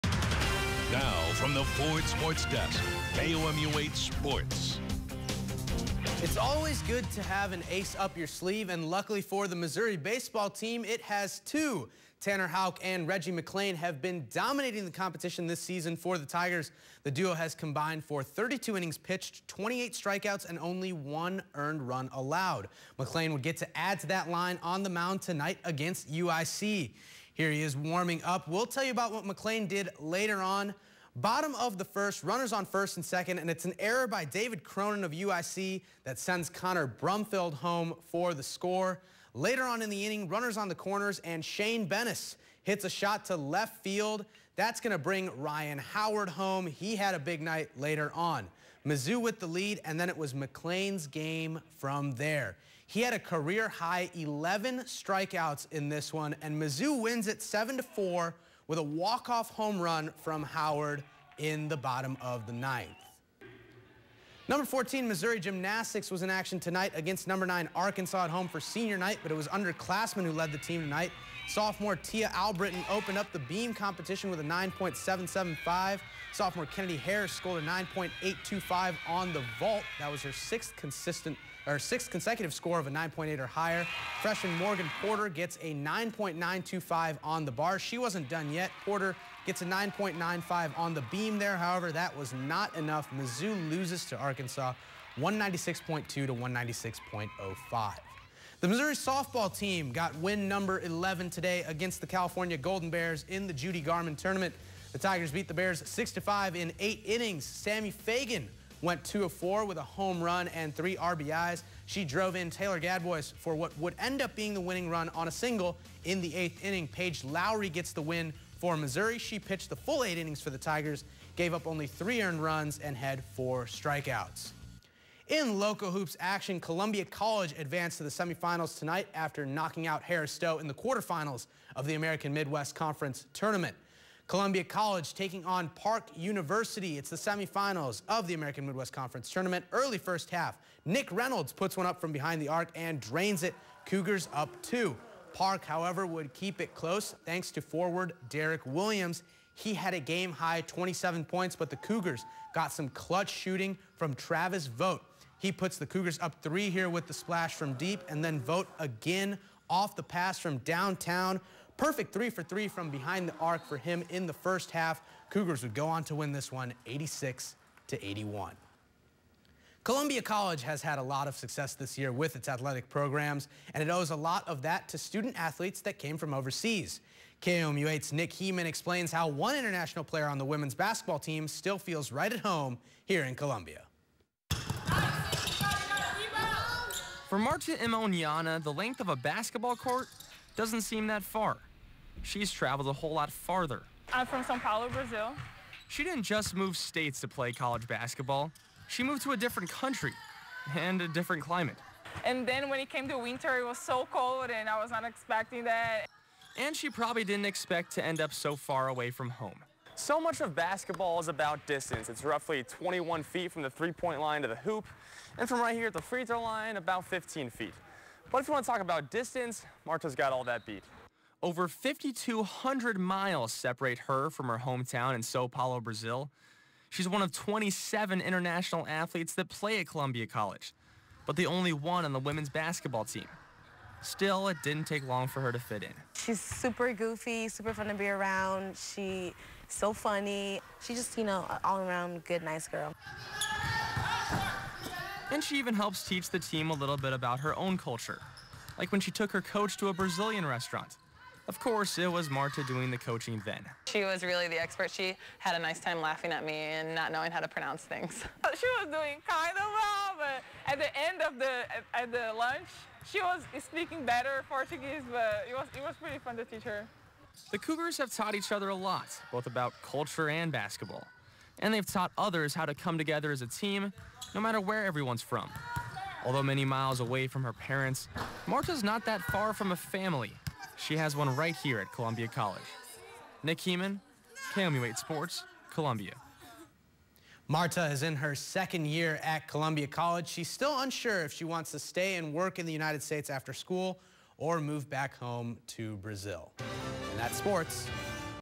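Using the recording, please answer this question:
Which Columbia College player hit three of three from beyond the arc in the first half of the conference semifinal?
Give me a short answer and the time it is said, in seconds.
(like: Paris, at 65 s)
Travis Vote, at 154 s.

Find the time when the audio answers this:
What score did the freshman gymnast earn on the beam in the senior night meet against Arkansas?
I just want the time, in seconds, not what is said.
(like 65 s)
89 s.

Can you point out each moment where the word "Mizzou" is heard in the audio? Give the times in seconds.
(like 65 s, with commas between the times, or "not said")
48 s, 56 s, 93 s.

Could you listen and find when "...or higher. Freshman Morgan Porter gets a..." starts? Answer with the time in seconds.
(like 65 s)
83 s.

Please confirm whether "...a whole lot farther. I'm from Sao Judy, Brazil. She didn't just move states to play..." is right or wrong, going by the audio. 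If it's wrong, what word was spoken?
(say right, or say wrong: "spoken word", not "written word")
wrong: "Paulo", not "Judy".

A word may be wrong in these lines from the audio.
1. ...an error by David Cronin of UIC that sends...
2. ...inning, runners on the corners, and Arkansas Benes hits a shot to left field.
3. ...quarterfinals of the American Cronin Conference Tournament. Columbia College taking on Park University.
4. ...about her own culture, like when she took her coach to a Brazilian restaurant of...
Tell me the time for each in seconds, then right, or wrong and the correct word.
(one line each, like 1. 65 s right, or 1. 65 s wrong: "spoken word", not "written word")
1. 33 s right
2. 40 s wrong: "Shane", not "Arkansas"
3. 130 s wrong: "Midwest", not "Cronin"
4. 247 s right.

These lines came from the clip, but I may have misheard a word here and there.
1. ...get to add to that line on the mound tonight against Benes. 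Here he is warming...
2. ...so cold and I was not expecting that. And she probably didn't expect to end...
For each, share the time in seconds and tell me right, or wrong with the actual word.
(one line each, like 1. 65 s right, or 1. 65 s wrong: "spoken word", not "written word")
1. 23 s wrong: "UIC", not "Benes"
2. 203 s right.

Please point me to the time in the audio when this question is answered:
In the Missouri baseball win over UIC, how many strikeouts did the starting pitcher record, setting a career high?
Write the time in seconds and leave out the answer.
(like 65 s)
54 s.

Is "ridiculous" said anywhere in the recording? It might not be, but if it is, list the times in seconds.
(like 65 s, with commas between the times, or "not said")
not said.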